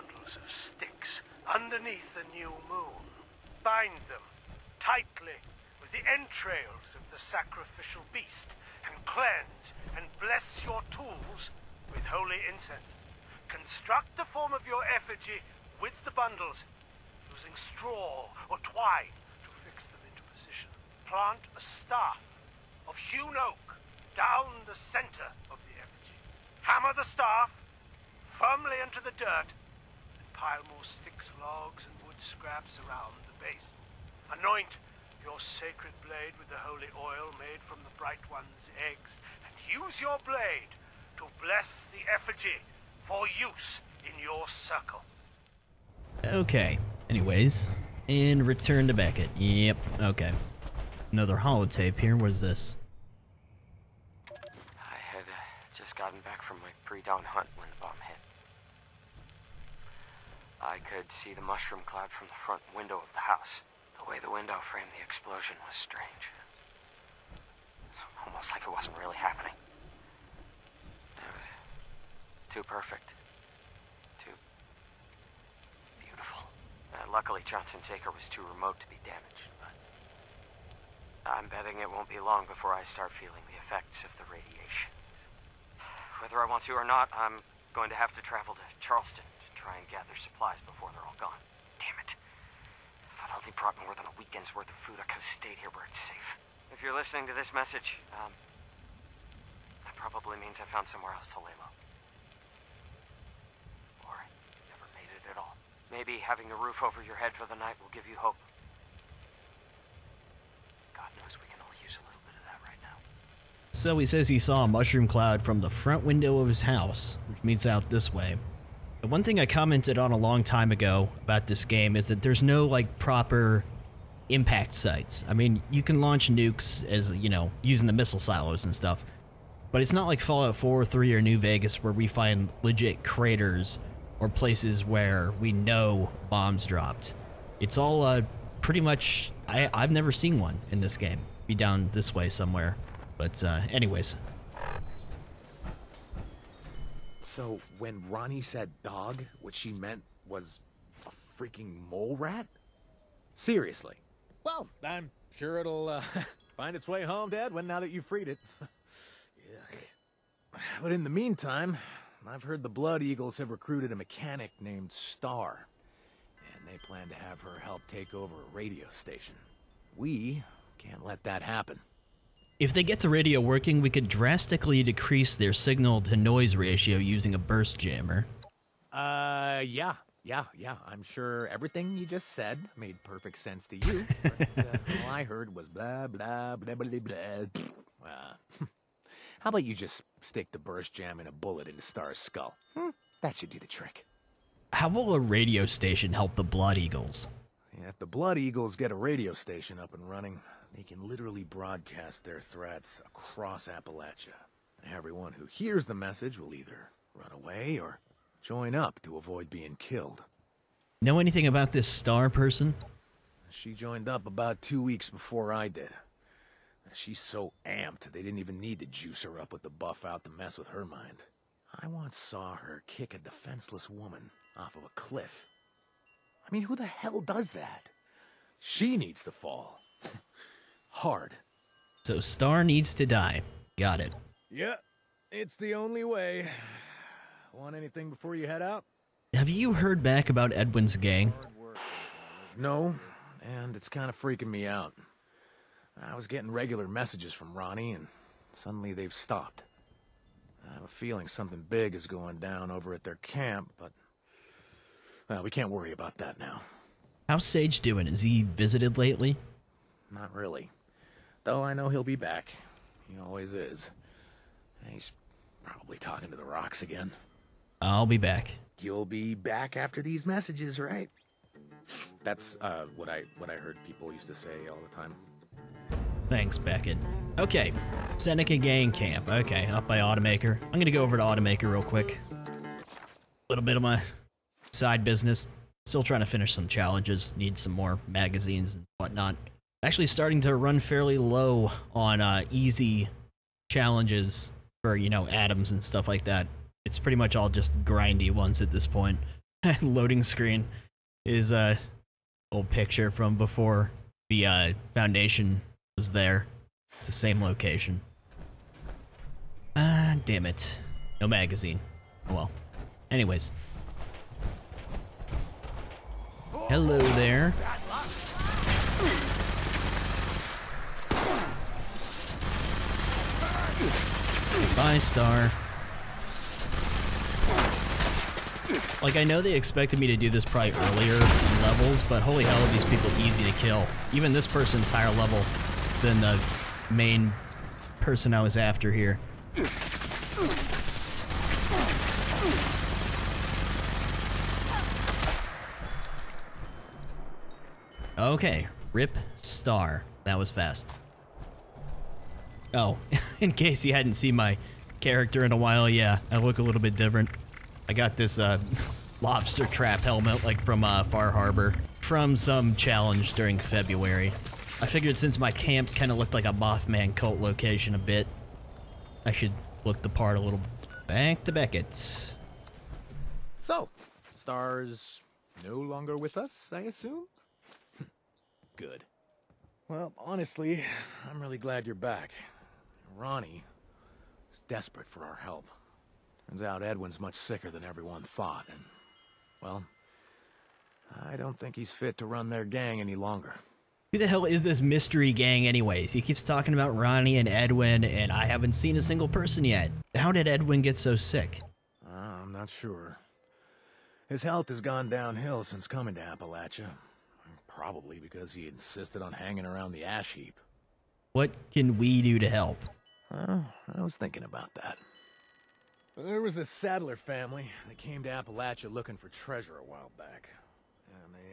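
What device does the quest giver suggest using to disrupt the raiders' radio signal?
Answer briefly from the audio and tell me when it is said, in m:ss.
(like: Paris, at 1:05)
a burst jammer, at 2:57.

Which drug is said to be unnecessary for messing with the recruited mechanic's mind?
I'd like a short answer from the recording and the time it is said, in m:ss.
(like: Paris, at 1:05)
Buffout, at 3:39.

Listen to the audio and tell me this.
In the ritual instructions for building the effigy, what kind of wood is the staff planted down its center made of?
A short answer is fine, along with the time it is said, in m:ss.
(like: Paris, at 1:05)
hewn oak, at 0:22.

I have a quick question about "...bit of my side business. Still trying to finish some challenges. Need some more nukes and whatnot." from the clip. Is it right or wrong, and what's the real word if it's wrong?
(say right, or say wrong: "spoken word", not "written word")
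wrong: "magazines", not "nukes".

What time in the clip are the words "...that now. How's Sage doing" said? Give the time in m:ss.
4:16.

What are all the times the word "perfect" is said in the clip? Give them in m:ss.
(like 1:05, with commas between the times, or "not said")
1:12, 3:03.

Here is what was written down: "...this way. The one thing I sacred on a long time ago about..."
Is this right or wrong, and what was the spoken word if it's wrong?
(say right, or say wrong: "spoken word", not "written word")
wrong: "commented", not "sacred".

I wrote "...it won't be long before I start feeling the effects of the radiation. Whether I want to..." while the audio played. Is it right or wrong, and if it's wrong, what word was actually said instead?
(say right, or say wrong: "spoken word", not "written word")
right.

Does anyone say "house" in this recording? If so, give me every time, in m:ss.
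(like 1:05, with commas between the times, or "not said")
1:03, 1:56.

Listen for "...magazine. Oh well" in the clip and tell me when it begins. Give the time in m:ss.
5:11.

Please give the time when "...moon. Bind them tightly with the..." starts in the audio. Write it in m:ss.
0:02.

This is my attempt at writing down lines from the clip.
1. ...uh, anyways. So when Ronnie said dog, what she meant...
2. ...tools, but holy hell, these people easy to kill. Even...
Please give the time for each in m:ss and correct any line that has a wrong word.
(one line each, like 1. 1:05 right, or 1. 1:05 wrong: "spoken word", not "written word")
1. 2:23 right
2. 5:31 wrong: "levels", not "tools".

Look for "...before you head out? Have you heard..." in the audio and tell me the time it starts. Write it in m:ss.
3:58.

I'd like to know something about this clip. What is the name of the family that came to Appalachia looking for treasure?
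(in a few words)
Sadler.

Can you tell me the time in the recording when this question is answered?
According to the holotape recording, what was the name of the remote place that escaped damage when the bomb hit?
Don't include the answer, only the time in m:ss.
1:17.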